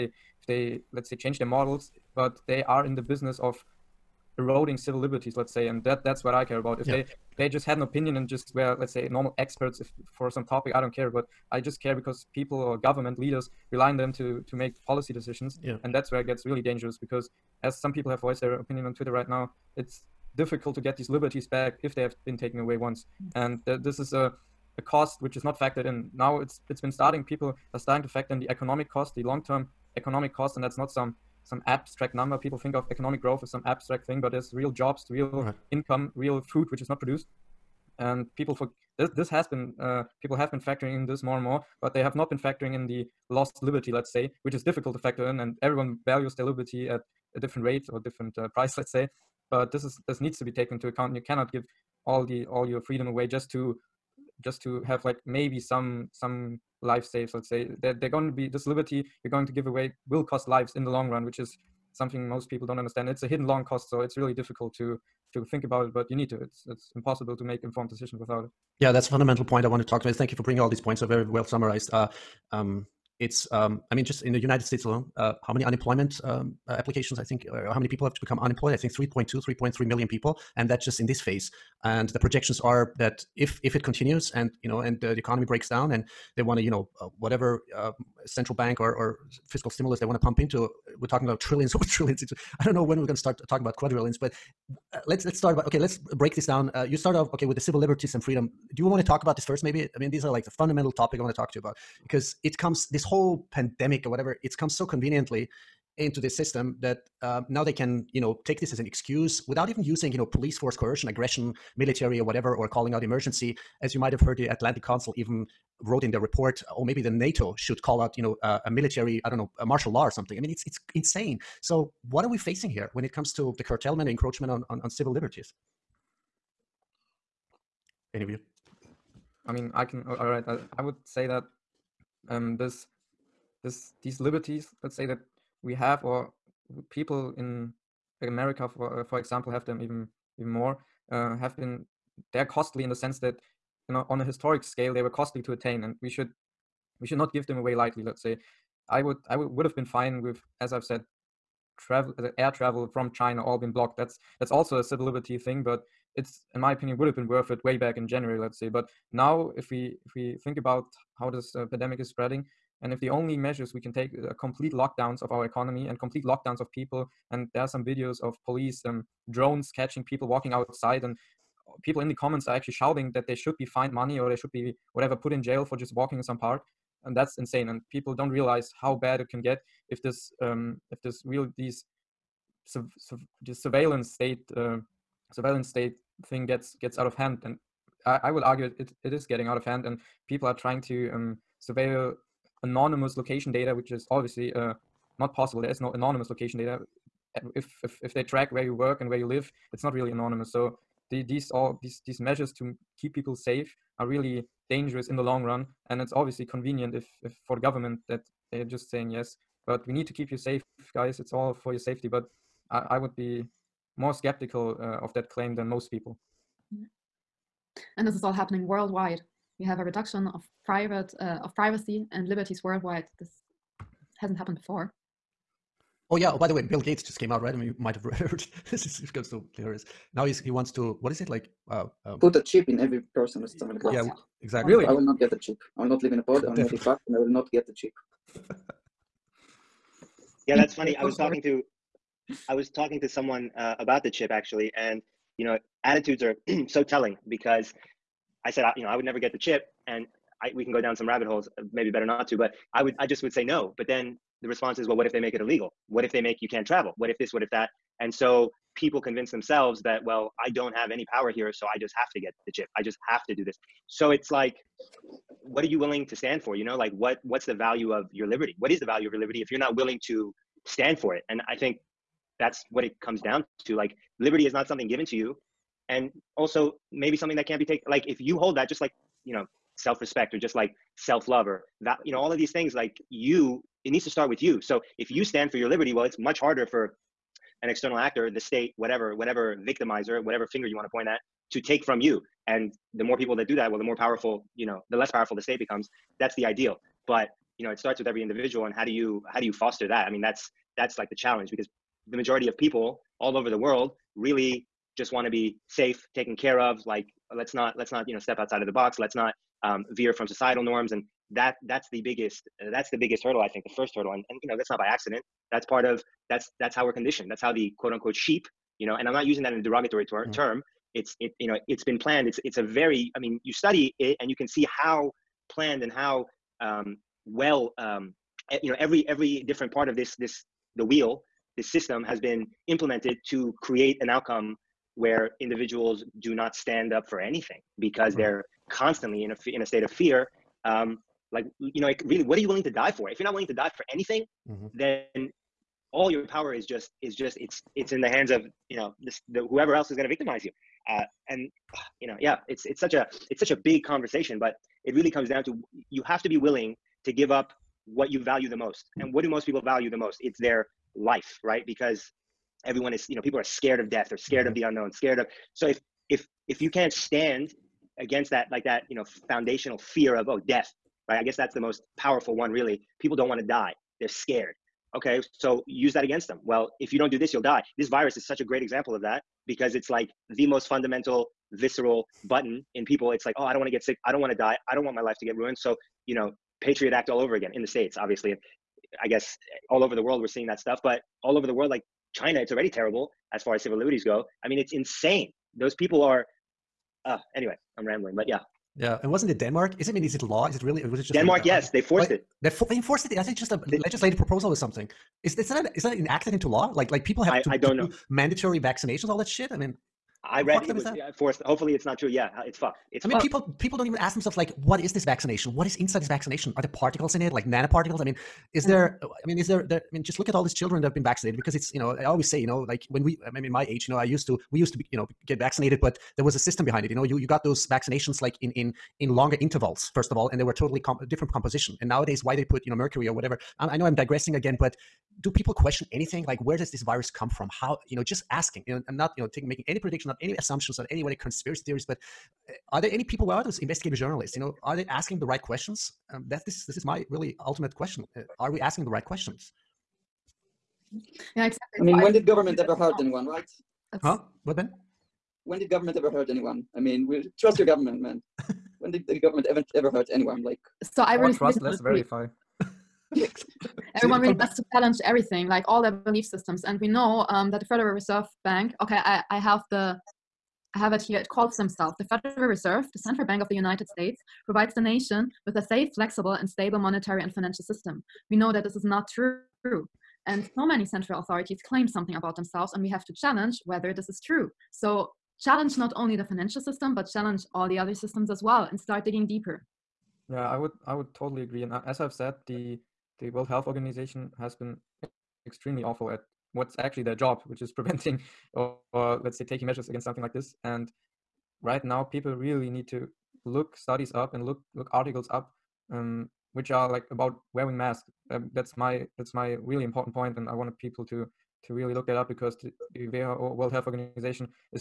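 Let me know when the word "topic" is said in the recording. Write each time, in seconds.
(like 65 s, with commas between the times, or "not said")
10 s, 100 s.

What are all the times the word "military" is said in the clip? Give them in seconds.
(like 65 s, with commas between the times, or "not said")
111 s, 118 s.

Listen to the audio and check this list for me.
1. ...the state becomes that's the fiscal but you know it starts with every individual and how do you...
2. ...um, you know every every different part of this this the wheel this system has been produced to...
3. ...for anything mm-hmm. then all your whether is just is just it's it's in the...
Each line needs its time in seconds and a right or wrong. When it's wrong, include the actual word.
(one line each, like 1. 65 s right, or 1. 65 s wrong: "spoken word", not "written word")
1. 295 s wrong: "ideal", not "fiscal"
2. 327 s wrong: "implemented", not "produced"
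3. 343 s wrong: "power", not "whether".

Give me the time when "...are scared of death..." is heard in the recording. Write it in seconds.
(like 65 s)
363 s.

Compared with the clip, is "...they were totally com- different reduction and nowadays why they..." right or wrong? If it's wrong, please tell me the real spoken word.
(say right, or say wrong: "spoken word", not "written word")
wrong: "composition", not "reduction".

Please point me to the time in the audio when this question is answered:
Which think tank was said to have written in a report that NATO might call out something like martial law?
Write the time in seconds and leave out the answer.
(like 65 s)
114 s.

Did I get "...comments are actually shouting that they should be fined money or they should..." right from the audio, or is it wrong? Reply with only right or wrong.
right.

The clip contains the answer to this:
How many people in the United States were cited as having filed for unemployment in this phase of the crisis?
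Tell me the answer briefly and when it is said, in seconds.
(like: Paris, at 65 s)
3.3 million, at 79 s.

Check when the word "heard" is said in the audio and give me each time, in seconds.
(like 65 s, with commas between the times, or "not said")
114 s, 228 s.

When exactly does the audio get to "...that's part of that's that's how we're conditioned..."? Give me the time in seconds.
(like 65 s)
315 s.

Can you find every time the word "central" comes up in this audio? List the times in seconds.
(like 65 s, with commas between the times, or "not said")
88 s, 472 s, 480 s.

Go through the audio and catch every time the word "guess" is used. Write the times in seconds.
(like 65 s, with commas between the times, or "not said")
371 s, 389 s.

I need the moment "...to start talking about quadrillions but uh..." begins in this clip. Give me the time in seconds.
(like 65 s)
93 s.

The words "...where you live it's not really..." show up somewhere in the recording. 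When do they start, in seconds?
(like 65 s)
199 s.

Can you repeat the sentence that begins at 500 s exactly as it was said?
And right now, people really need to look studies up and look look articles up, um, which are like about wearing masks.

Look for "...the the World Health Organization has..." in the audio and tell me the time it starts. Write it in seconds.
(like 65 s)
492 s.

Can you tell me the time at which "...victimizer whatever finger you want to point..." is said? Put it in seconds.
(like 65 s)
289 s.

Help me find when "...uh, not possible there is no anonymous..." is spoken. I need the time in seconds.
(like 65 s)
194 s.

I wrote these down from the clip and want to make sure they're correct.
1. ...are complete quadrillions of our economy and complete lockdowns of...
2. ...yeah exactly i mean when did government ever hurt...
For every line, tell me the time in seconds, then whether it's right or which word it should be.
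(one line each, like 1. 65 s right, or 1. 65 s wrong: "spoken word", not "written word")
1. 164 s wrong: "lockdowns", not "quadrillions"
2. 451 s right.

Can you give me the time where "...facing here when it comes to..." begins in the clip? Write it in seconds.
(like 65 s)
122 s.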